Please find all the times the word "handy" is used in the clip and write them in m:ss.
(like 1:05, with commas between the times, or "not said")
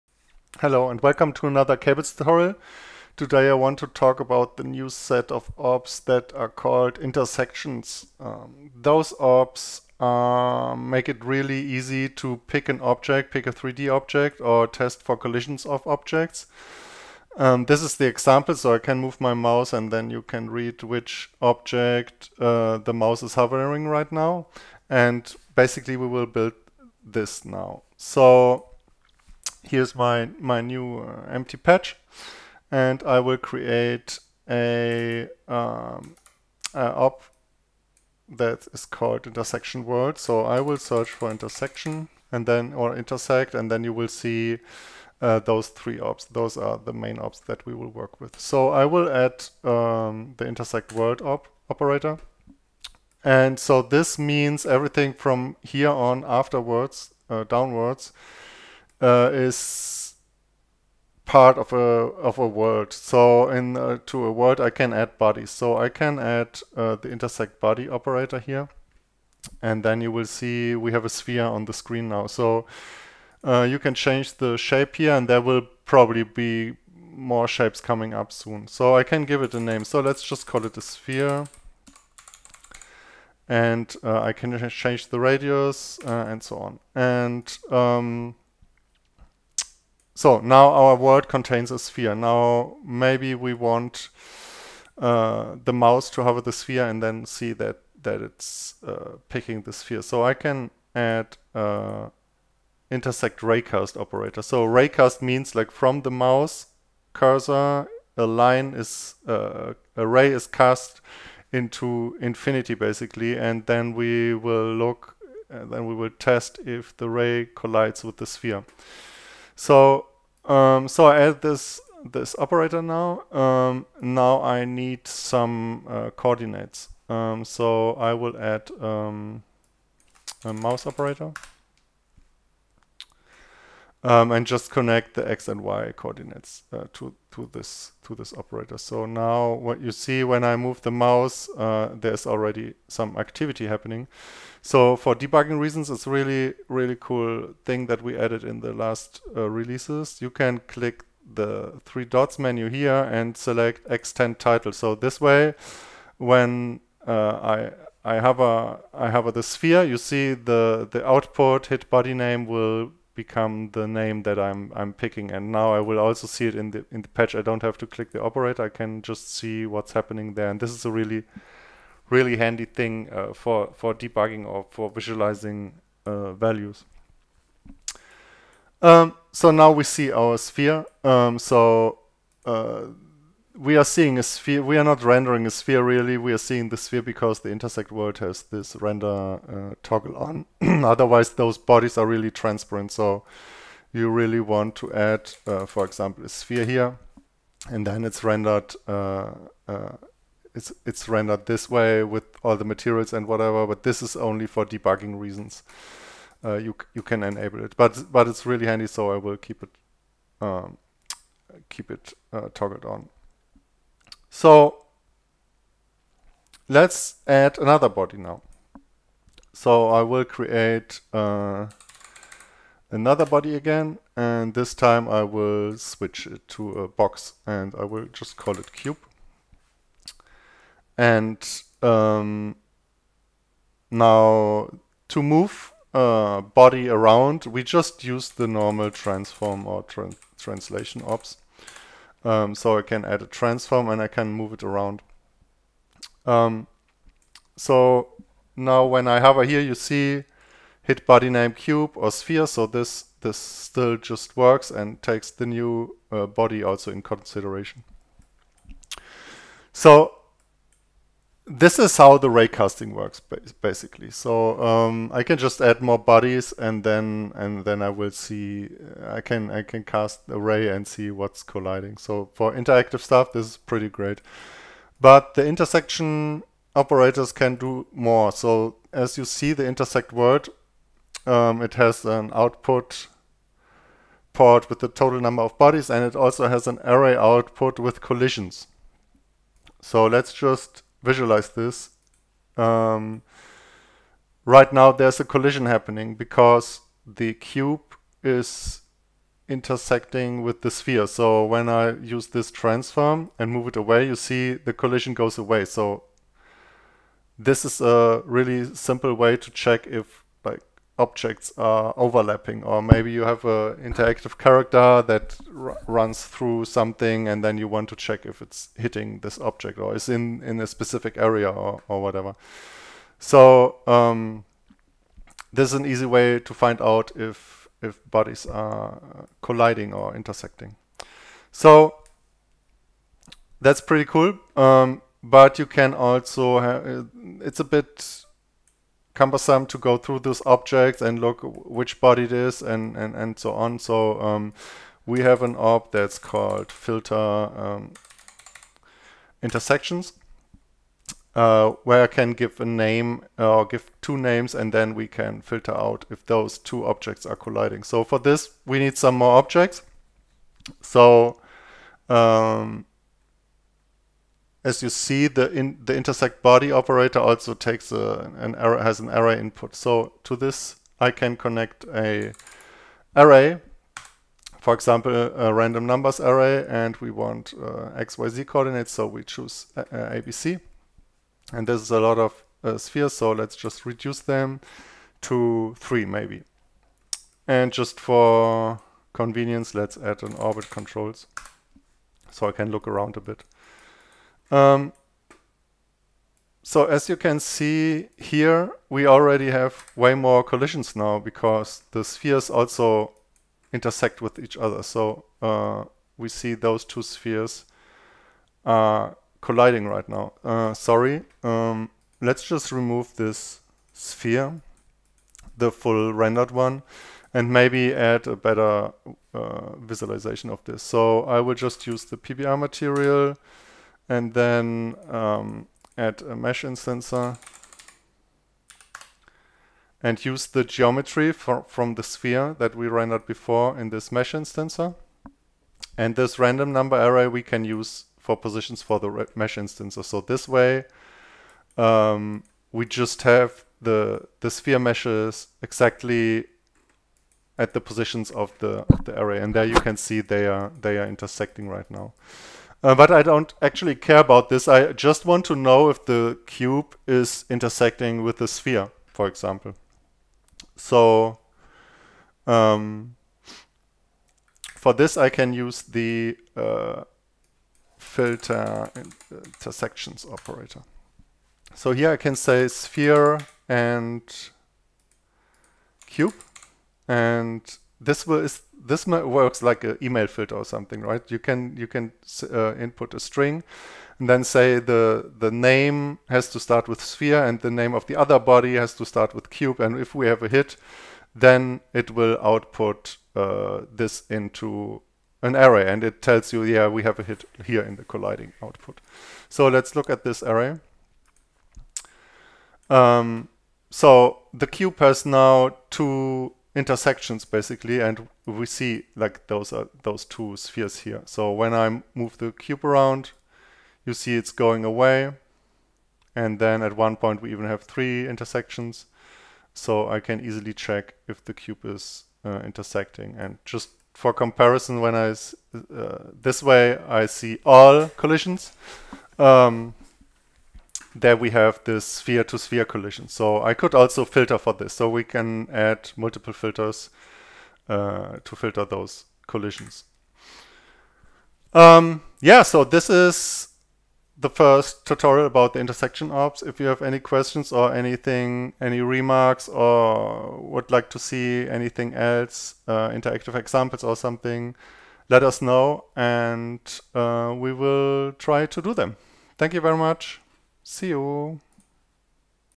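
2:52, 3:28.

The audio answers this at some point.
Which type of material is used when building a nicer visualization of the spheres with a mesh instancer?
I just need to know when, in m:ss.
7:02.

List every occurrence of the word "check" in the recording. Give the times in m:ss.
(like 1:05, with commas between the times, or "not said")
5:09, 5:17, 8:40.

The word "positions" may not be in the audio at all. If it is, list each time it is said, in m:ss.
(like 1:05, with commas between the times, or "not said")
7:18, 7:27.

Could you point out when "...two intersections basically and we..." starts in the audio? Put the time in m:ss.
8:25.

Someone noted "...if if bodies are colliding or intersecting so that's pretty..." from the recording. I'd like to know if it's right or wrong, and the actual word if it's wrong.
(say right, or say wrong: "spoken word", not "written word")
right.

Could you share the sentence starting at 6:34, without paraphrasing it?
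Um, so as you can see here, we already have way more collisions now because the spheres also intersect with each other.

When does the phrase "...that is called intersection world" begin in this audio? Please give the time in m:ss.
0:38.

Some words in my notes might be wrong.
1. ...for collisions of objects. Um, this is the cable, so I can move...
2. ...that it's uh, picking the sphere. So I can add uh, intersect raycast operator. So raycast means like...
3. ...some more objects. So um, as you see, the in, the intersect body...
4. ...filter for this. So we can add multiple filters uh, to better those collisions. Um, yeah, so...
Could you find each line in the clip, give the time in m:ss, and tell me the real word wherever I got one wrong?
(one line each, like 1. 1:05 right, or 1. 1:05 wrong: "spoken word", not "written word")
1. 0:15 wrong: "example", not "cable"
2. 1:38 right
3. 5:58 right
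4. 8:54 wrong: "filter", not "better".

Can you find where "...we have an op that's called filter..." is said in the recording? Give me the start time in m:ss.
5:45.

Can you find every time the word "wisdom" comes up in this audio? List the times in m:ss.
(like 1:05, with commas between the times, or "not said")
not said.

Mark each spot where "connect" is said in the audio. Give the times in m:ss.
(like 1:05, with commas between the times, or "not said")
2:14, 6:11.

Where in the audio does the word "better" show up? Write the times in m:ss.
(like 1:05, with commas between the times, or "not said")
6:58.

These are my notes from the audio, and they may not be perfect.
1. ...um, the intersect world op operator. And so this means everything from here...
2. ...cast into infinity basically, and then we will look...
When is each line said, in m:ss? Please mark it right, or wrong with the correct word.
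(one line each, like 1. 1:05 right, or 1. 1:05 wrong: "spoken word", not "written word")
1. 0:49 right
2. 1:50 right.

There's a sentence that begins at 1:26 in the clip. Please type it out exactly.
And um, so now our world contains a sphere.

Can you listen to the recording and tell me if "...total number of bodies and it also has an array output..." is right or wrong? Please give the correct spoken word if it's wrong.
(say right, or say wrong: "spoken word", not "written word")
right.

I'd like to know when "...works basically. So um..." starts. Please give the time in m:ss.
4:22.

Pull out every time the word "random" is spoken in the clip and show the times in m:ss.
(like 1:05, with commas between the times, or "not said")
6:15, 7:16.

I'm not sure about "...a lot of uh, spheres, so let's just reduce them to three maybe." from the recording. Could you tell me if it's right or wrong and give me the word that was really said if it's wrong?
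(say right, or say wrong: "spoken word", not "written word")
right.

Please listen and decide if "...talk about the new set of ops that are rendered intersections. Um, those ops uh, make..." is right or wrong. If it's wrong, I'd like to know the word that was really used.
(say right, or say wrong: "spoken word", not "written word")
wrong: "called", not "rendered".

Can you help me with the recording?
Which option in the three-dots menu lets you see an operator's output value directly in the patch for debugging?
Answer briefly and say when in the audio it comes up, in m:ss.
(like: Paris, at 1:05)
Extend title, at 2:33.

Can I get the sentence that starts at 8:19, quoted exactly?
So let's look at this array.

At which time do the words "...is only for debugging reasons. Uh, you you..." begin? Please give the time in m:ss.
3:24.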